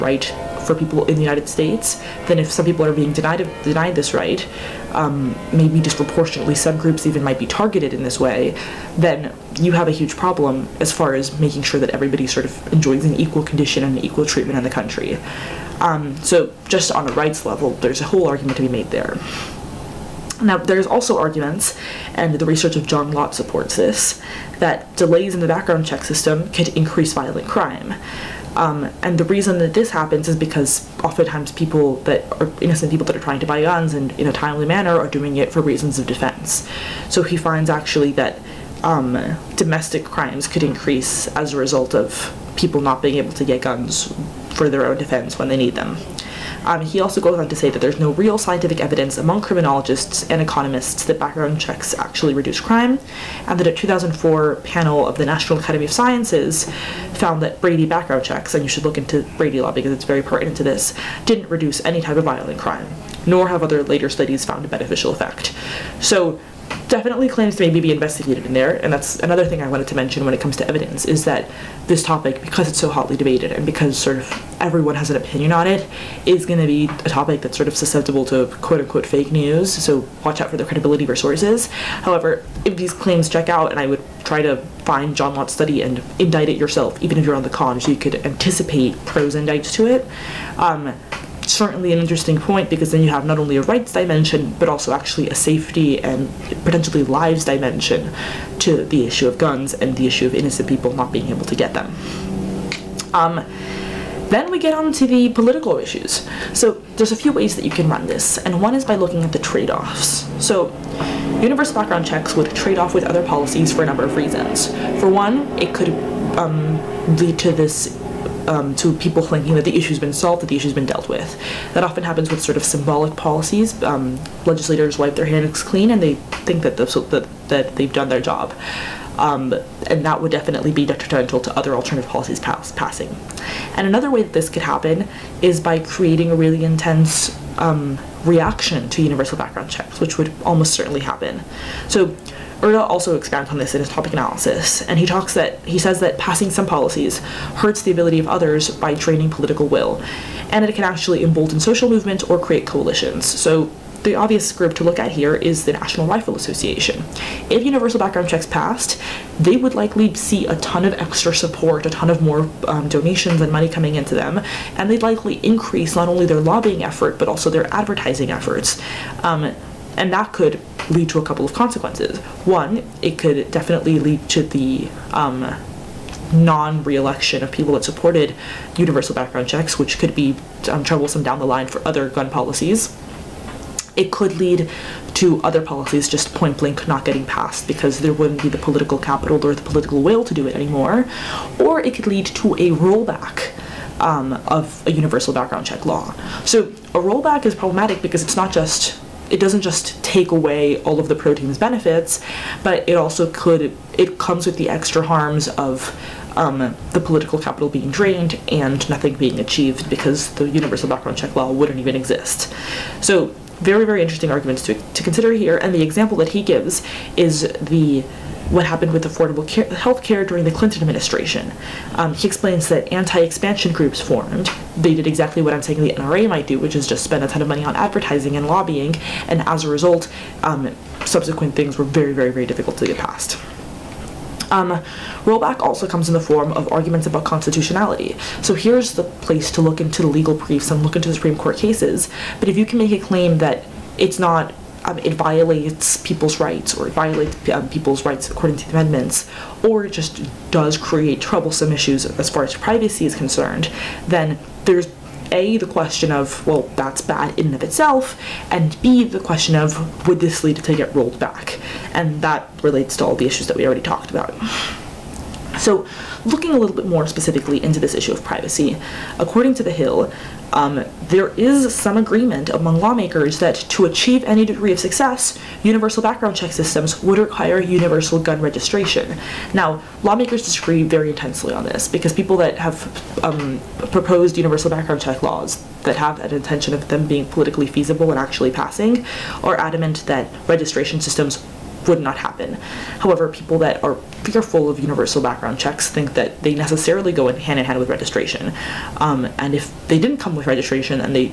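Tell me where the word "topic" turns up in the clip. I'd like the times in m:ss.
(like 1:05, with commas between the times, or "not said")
1:12, 1:17, 2:23.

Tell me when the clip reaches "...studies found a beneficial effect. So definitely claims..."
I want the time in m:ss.
1:04.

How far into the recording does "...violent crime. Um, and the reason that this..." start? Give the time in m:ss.
0:27.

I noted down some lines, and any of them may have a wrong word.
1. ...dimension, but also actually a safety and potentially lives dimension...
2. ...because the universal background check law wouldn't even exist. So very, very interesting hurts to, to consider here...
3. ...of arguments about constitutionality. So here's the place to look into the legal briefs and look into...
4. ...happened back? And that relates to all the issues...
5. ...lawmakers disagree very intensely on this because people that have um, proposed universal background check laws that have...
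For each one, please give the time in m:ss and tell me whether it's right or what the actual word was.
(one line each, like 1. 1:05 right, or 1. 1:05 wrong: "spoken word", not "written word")
1. 1:33 right
2. 3:29 wrong: "arguments", not "hurts"
3. 3:56 right
4. 4:20 wrong: "rolled", not "happened"
5. 4:40 right.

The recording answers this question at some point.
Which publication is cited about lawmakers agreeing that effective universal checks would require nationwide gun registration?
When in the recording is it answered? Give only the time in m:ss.
4:29.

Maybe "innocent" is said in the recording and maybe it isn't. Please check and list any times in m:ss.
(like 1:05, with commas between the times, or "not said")
0:32, 1:40.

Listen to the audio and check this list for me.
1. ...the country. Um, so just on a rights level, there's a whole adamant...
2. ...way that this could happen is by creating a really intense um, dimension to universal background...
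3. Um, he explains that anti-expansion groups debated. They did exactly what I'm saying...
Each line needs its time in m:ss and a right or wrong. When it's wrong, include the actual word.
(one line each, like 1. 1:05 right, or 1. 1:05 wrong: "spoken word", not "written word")
1. 0:14 wrong: "argument", not "adamant"
2. 2:14 wrong: "reaction", not "dimension"
3. 3:41 wrong: "formed", not "debated".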